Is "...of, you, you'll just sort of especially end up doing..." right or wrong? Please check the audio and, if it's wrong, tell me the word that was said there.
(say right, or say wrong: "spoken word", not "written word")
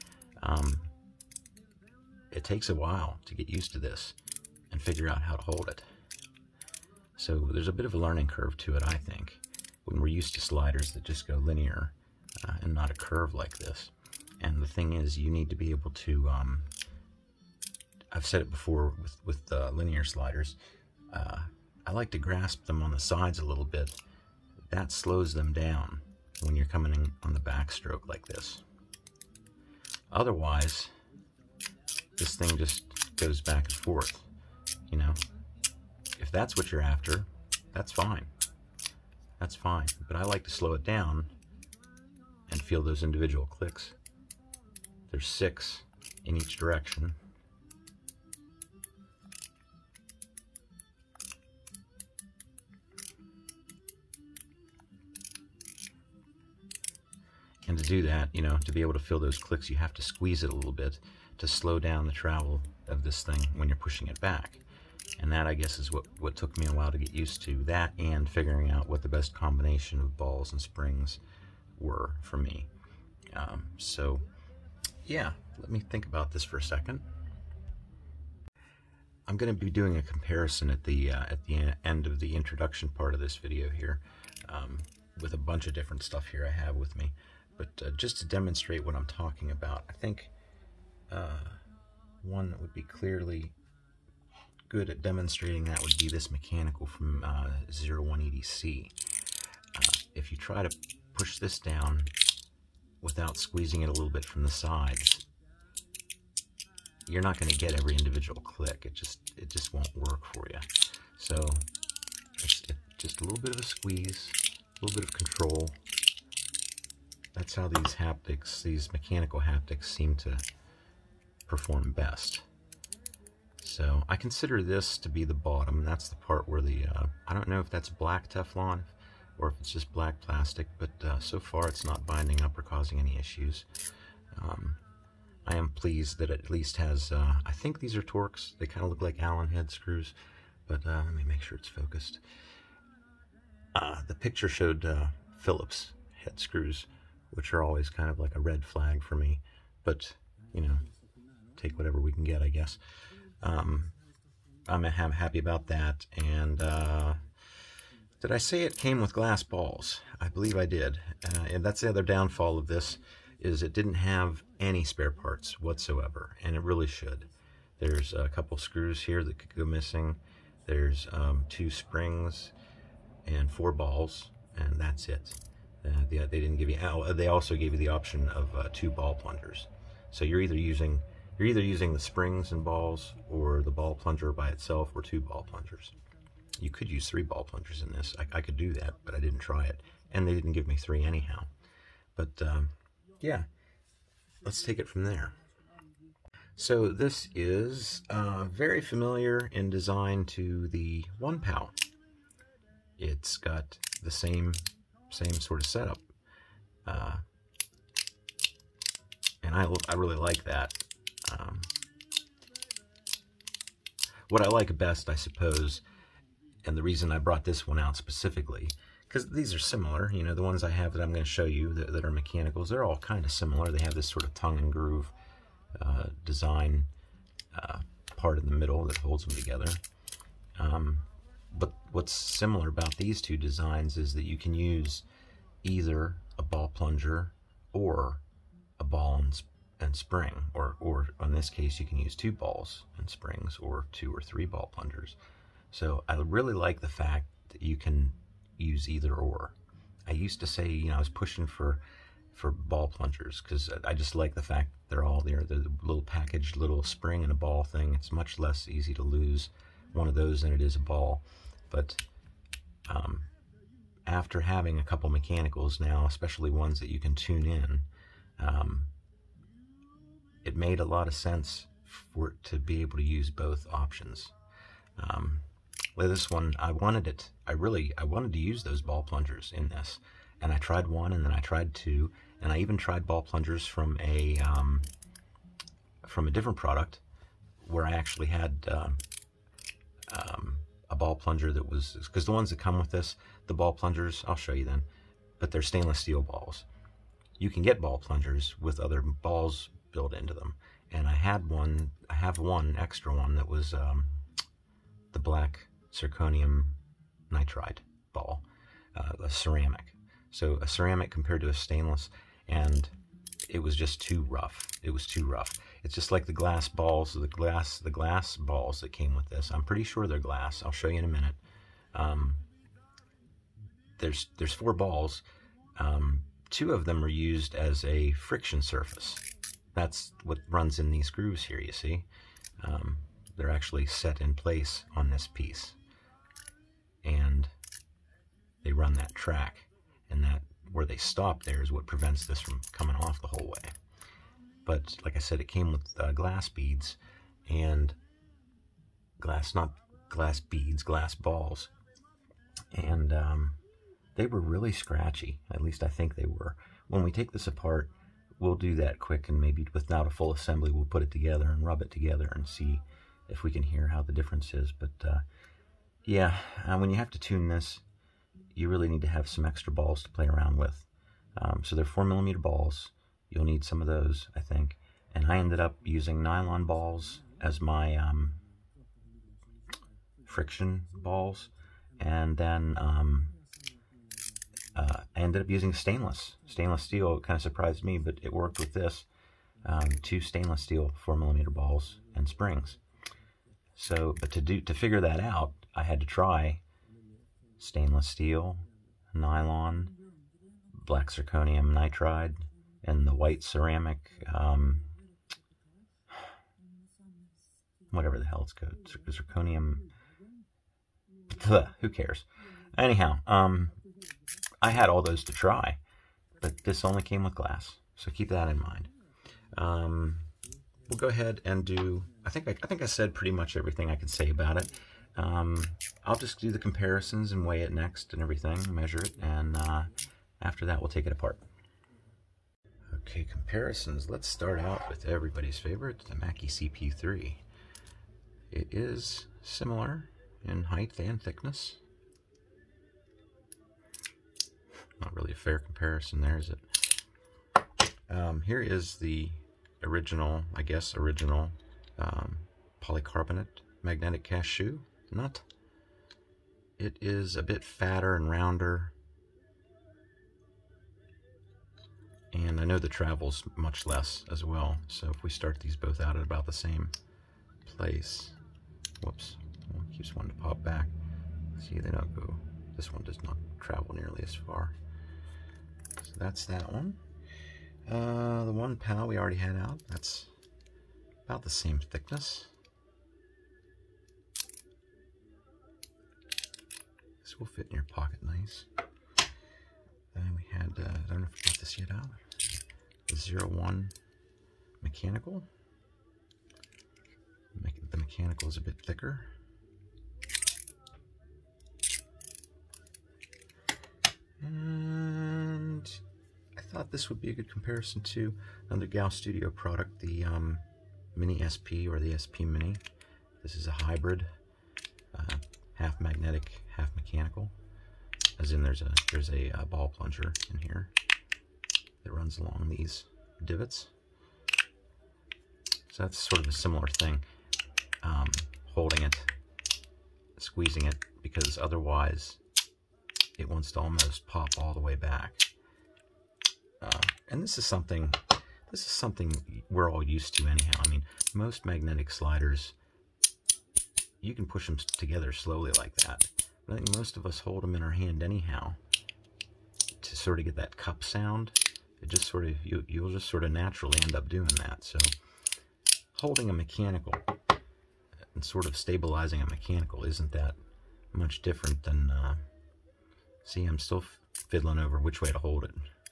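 wrong: "naturally", not "especially".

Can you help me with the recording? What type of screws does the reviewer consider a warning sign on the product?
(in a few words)
Phillips head.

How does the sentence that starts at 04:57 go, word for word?
You can get ball plungers with other balls built into them.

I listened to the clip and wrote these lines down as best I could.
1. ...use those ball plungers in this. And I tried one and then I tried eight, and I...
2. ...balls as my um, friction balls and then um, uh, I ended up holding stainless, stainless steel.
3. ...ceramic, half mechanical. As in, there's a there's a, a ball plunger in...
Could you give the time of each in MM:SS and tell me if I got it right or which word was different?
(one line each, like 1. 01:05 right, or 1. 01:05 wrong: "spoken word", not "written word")
1. 04:38 wrong: "two", not "eight"
2. 06:16 wrong: "using", not "holding"
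3. 08:36 wrong: "magnetic", not "ceramic".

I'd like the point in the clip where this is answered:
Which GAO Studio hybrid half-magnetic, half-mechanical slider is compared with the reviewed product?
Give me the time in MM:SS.
08:32.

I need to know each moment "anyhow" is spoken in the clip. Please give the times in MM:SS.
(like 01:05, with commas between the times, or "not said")
03:11, 06:52, 09:00, 09:08.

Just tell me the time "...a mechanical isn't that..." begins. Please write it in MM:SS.
09:19.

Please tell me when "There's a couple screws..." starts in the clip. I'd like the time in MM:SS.
02:47.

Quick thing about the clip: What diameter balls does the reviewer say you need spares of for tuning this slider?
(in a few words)
4 millimeters.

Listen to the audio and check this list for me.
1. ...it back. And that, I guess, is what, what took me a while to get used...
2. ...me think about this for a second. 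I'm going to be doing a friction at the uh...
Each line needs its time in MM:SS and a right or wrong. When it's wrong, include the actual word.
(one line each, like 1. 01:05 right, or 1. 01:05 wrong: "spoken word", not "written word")
1. 01:04 right
2. 01:15 wrong: "comparison", not "friction".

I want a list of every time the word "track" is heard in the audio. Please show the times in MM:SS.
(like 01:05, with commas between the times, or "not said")
05:39.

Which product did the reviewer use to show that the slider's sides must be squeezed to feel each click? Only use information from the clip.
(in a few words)
0180C.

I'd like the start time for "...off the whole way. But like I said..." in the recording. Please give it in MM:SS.
05:42.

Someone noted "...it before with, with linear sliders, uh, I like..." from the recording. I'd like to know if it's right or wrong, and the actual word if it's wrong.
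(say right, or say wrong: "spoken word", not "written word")
right.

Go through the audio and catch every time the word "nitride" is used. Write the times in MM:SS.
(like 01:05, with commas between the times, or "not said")
05:07, 06:41.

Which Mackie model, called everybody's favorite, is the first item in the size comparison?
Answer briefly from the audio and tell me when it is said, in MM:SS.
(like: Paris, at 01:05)
CP3, at 07:16.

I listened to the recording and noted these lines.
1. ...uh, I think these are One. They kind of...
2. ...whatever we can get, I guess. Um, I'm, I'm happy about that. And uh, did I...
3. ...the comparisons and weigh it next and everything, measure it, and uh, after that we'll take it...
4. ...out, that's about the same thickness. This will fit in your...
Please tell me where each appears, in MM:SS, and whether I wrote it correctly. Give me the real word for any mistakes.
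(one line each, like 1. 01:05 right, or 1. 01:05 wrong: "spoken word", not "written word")
1. 02:17 wrong: "Torx", not "One"
2. 02:31 right
3. 07:06 right
4. 07:59 right.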